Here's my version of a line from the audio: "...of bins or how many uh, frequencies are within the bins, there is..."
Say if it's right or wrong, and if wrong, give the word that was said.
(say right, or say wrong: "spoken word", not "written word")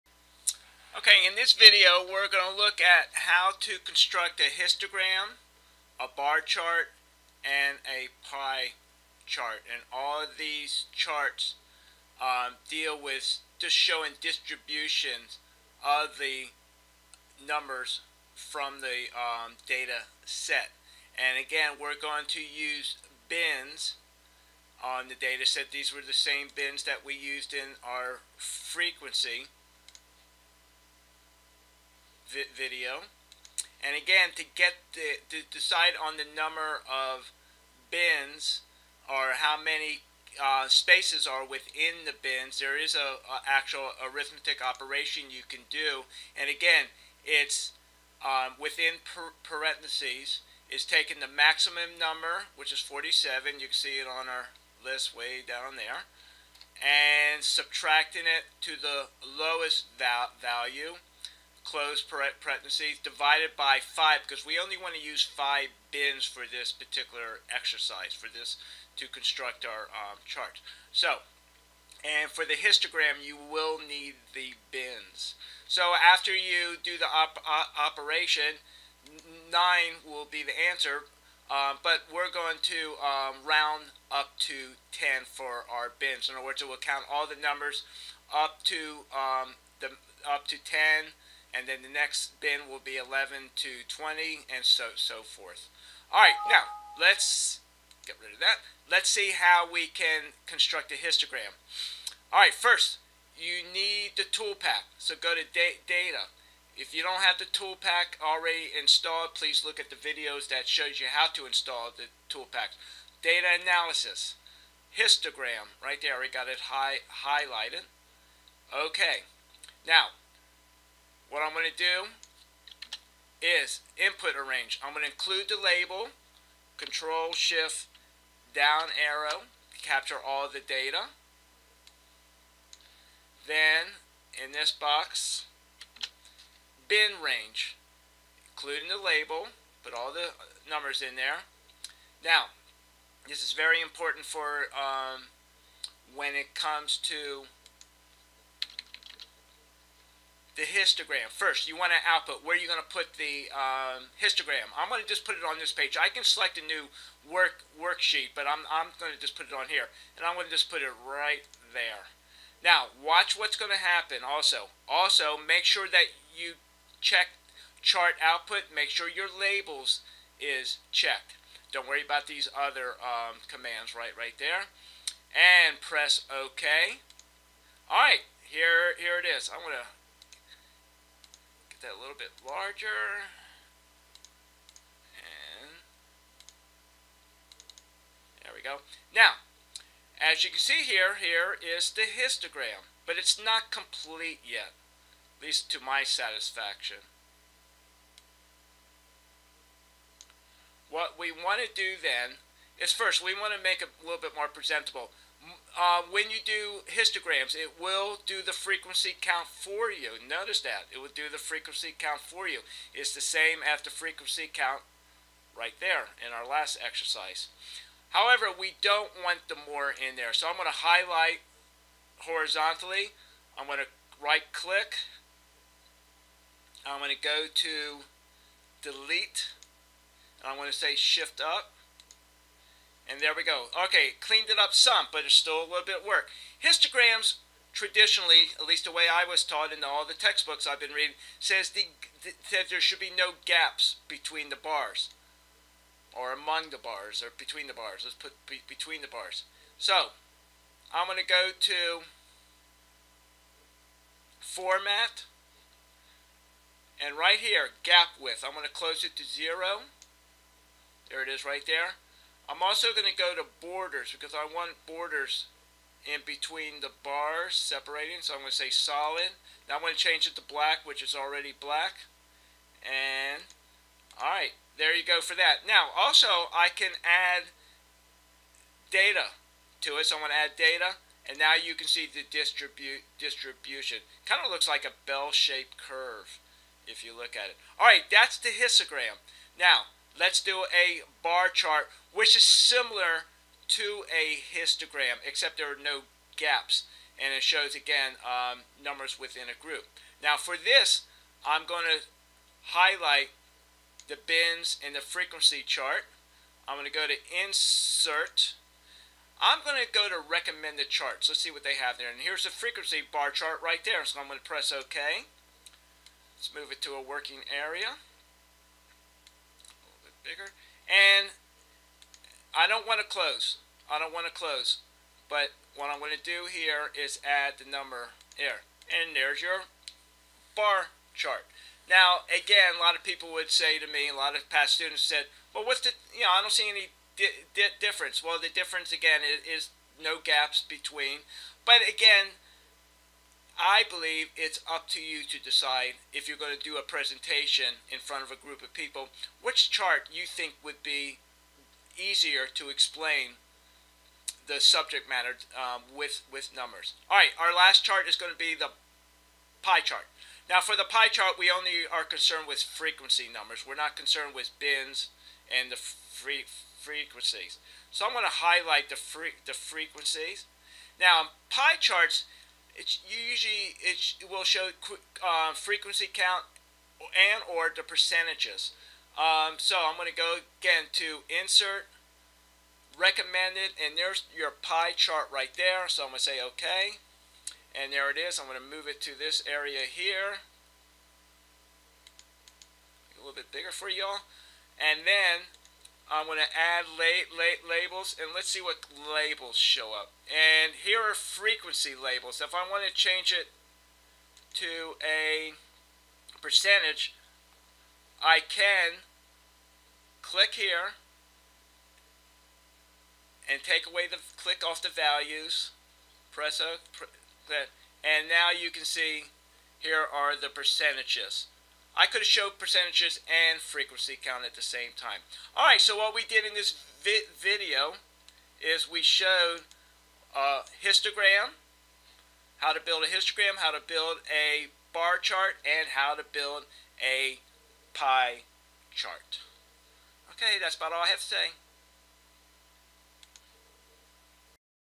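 wrong: "spaces", not "frequencies".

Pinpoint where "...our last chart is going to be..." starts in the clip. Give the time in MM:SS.
05:57.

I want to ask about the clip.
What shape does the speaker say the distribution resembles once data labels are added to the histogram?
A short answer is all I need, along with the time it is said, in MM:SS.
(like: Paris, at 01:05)
bell-shaped curve, at 04:45.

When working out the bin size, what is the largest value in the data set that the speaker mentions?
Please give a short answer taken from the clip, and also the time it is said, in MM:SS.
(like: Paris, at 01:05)
47, at 00:52.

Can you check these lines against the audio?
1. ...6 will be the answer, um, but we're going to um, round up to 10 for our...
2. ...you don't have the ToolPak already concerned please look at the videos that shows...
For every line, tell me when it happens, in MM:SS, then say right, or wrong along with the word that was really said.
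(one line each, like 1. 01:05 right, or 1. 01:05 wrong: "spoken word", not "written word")
1. 01:19 wrong: "9", not "6"
2. 01:46 wrong: "installed", not "concerned".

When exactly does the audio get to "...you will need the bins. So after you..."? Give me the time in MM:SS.
01:13.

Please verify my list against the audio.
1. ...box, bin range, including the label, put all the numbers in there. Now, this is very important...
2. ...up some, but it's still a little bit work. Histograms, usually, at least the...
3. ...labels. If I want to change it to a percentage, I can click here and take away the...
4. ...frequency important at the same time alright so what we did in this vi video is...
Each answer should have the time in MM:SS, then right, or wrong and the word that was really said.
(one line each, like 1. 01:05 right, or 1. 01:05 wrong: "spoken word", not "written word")
1. 02:14 right
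2. 03:54 wrong: "traditionally", not "usually"
3. 06:41 right
4. 07:03 wrong: "count", not "important".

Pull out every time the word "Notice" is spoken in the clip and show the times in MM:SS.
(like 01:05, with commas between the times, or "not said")
03:30.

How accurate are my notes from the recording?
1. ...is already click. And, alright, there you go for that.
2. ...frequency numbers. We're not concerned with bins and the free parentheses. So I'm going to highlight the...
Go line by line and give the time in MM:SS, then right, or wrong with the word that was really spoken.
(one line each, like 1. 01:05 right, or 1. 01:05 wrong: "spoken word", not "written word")
1. 04:31 wrong: "black", not "click"
2. 06:02 wrong: "frequencies", not "parentheses".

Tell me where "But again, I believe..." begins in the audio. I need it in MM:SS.
05:41.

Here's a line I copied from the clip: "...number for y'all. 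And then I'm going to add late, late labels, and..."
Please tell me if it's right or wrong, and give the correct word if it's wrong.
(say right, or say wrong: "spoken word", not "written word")
wrong: "bigger", not "number".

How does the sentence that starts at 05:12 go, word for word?
And here's the frequency bar chart right there.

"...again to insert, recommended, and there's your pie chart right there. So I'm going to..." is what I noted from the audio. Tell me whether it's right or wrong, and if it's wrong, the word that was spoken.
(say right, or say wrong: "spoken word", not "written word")
right.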